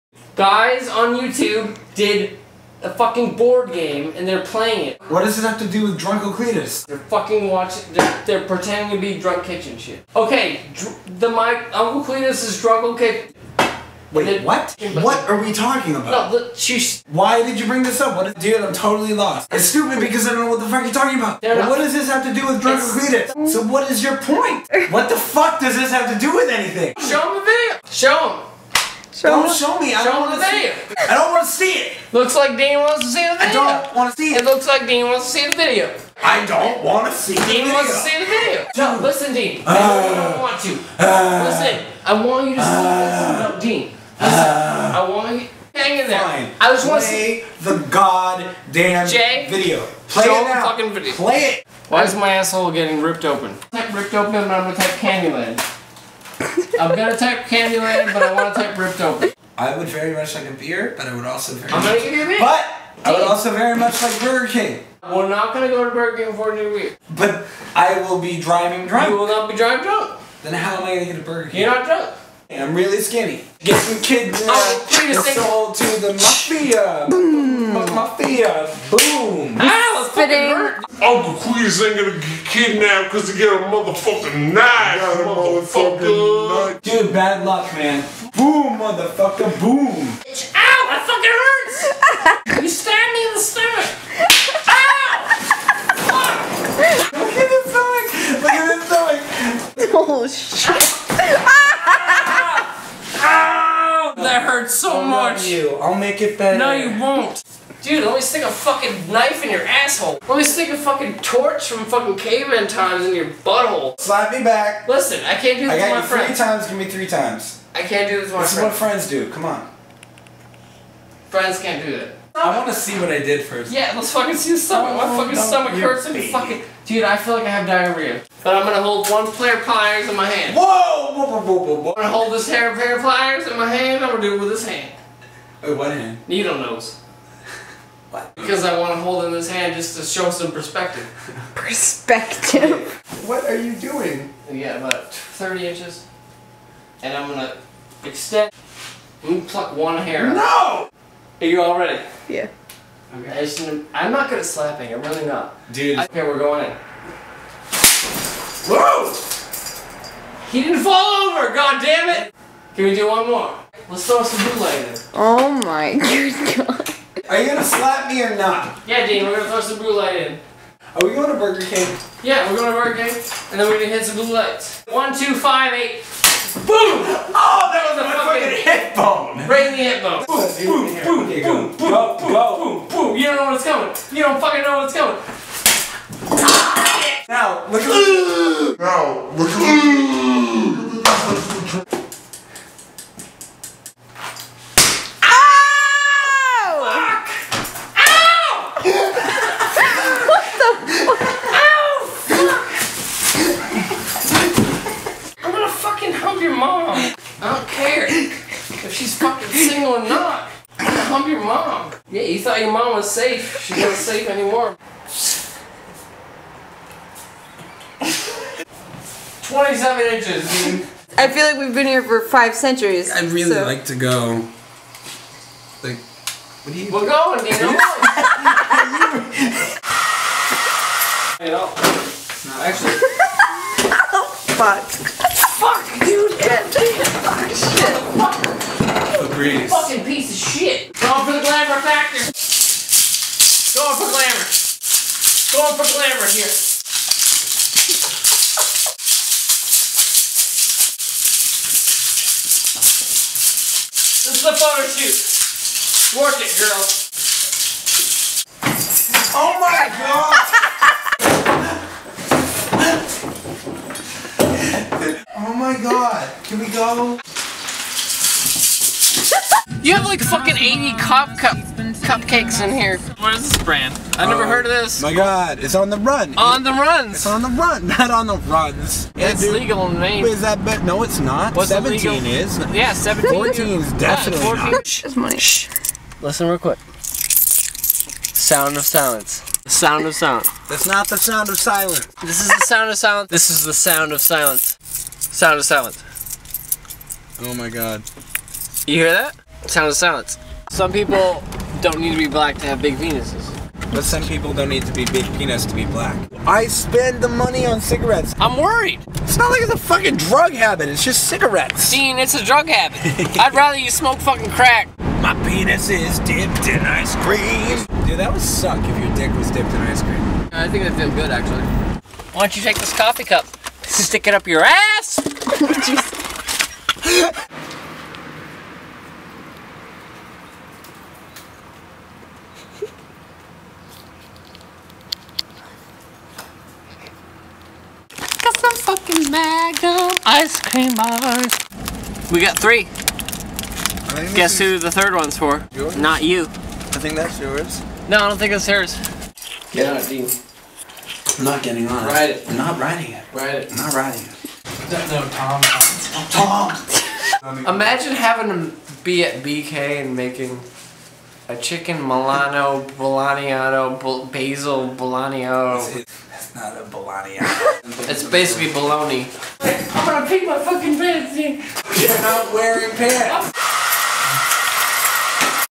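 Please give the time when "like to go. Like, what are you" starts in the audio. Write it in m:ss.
3:43.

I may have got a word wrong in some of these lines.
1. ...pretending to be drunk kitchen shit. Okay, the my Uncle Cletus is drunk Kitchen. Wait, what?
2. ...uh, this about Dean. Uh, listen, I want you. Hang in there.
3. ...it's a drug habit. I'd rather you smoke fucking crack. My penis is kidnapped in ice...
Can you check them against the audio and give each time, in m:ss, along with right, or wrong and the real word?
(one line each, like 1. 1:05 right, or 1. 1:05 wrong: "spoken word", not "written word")
1. 0:08 right
2. 0:42 right
3. 5:12 wrong: "dipped", not "kidnapped".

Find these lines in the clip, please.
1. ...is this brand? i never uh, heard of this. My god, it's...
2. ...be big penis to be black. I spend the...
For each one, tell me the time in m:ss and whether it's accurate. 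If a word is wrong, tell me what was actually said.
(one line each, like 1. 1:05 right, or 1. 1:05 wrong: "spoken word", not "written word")
1. 4:33 right
2. 5:04 right.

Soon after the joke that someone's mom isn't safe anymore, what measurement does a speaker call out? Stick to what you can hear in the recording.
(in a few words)
27 inches.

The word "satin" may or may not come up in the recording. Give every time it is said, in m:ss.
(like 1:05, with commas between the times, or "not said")
not said.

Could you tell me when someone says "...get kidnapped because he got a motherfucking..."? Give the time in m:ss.
1:22.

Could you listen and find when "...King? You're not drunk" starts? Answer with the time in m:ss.
1:11.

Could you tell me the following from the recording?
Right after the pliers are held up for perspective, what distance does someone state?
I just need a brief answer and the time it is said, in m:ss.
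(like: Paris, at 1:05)
30 inches, at 2:24.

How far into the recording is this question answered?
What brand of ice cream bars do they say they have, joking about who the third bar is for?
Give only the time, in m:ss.
5:39.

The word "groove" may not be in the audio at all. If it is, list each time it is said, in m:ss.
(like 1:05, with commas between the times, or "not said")
not said.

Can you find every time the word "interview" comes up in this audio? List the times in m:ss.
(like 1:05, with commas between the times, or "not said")
not said.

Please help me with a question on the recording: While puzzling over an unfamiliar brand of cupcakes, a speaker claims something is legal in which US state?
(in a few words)
Maine.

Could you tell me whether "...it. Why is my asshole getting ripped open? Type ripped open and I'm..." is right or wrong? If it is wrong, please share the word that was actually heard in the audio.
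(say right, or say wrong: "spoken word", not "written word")
right.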